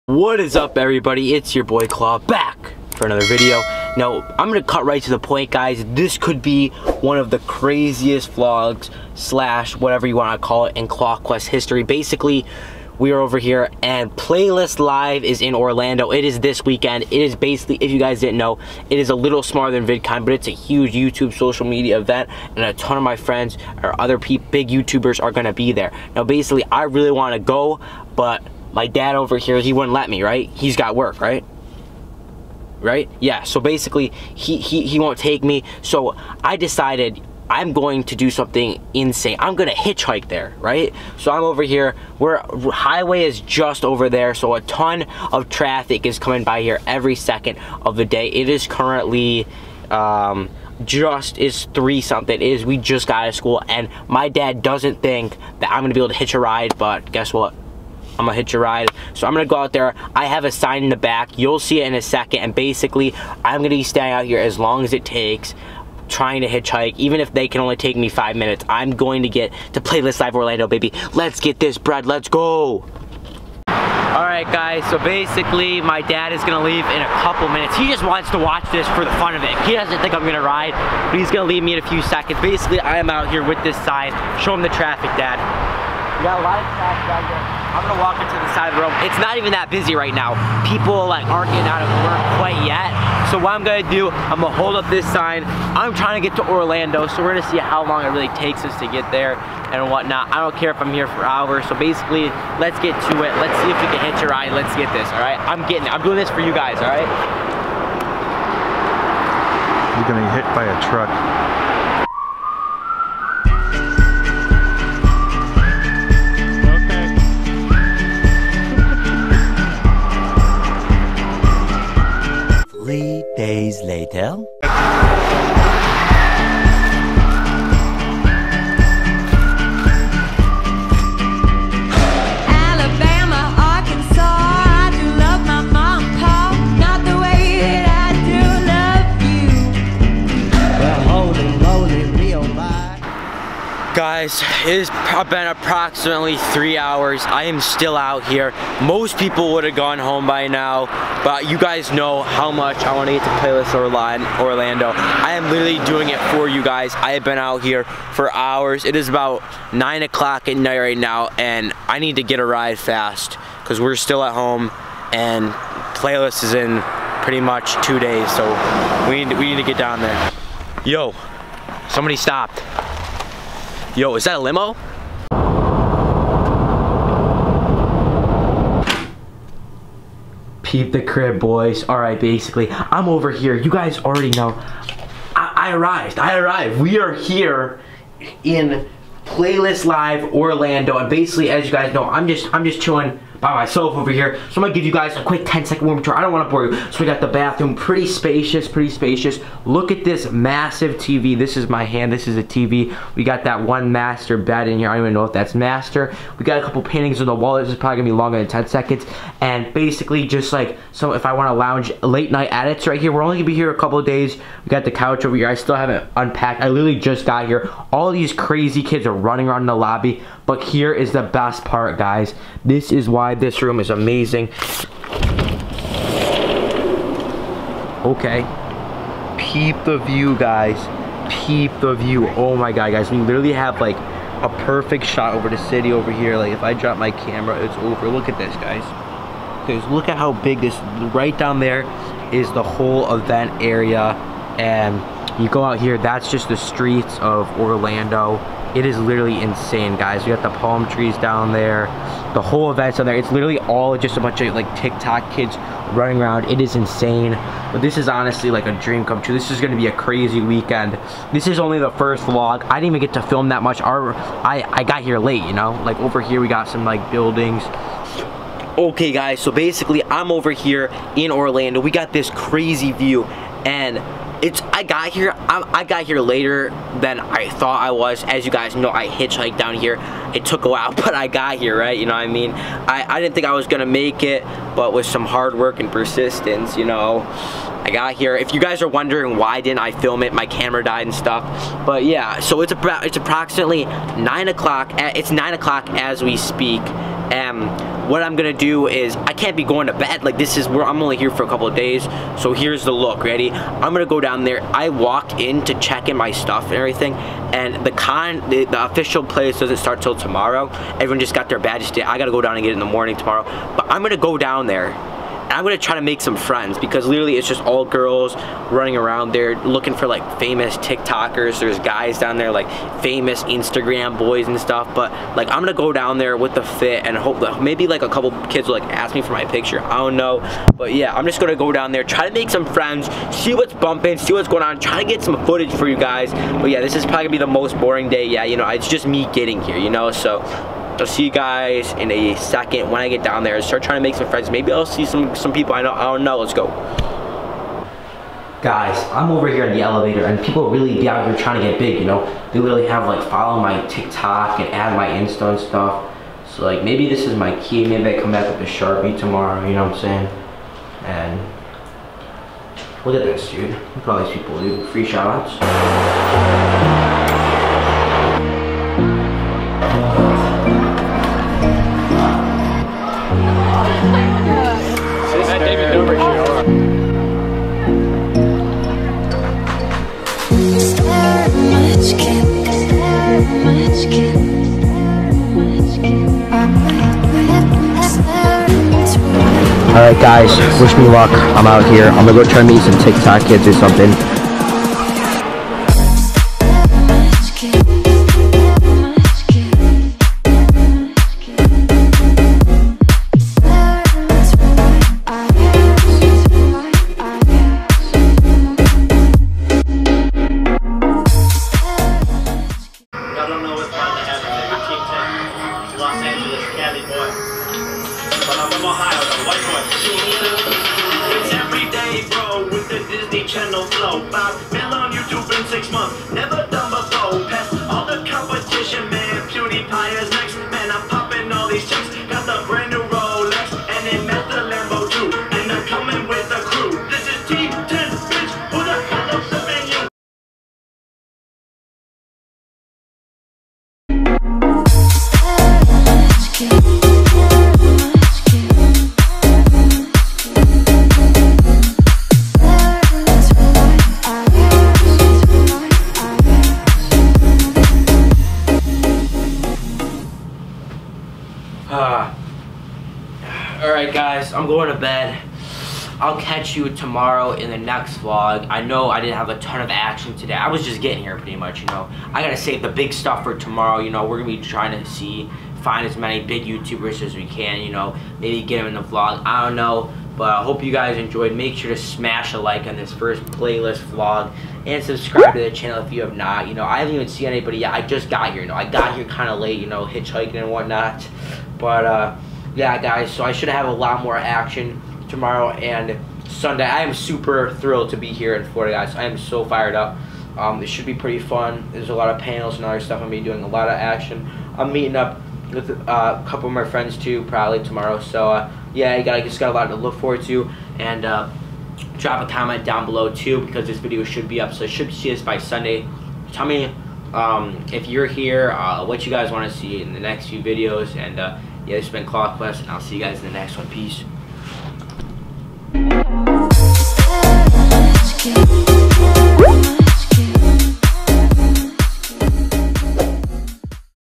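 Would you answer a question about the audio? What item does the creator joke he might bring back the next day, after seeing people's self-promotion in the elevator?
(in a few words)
Sharpie.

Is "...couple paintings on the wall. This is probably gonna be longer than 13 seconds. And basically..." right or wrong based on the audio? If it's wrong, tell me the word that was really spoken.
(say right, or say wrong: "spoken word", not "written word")
wrong: "10", not "13".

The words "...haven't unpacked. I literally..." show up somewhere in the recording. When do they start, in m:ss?
3:35.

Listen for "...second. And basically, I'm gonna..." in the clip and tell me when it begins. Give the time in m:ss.
1:02.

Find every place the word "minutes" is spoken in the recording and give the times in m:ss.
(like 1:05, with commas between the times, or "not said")
1:08, 1:17.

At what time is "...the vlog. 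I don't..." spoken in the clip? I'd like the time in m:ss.
7:58.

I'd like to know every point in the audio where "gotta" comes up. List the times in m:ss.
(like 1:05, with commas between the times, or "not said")
5:12, 7:52.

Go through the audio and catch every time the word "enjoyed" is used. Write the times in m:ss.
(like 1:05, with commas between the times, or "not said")
8:01.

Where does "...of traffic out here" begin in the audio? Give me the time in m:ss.
1:26.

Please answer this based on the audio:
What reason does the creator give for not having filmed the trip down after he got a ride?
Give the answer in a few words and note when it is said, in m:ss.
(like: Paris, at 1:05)
Camera died, at 4:50.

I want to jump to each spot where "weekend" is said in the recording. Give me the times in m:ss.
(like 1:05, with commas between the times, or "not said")
0:16, 4:20.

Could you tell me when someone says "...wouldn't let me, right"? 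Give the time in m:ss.
0:29.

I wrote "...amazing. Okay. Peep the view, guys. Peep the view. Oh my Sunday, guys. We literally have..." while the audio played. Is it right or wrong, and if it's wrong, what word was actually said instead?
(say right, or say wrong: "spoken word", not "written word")
wrong: "God", not "Sunday".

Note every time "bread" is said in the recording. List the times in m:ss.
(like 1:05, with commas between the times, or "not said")
1:11.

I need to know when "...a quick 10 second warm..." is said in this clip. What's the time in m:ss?
3:15.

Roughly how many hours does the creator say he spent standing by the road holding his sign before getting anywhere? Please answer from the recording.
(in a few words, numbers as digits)
3.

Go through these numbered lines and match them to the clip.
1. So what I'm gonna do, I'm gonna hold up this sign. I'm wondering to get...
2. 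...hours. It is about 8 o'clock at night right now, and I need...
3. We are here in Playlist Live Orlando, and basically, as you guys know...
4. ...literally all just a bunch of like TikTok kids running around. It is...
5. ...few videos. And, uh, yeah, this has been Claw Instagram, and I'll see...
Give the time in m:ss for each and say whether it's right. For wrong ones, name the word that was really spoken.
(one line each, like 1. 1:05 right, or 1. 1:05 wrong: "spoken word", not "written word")
1. 1:33 wrong: "trying", not "wondering"
2. 2:38 wrong: "9", not "8"
3. 3:06 right
4. 4:13 right
5. 8:40 wrong: "Quest", not "Instagram".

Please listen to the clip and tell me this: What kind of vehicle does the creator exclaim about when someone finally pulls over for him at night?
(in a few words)
Limo.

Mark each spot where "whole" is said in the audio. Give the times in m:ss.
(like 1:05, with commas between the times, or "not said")
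4:02, 4:12.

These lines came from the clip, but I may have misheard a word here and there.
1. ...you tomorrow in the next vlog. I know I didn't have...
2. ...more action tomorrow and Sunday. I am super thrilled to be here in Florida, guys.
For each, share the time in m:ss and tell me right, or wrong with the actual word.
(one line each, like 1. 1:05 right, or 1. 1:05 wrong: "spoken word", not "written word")
1. 7:46 right
2. 8:14 right.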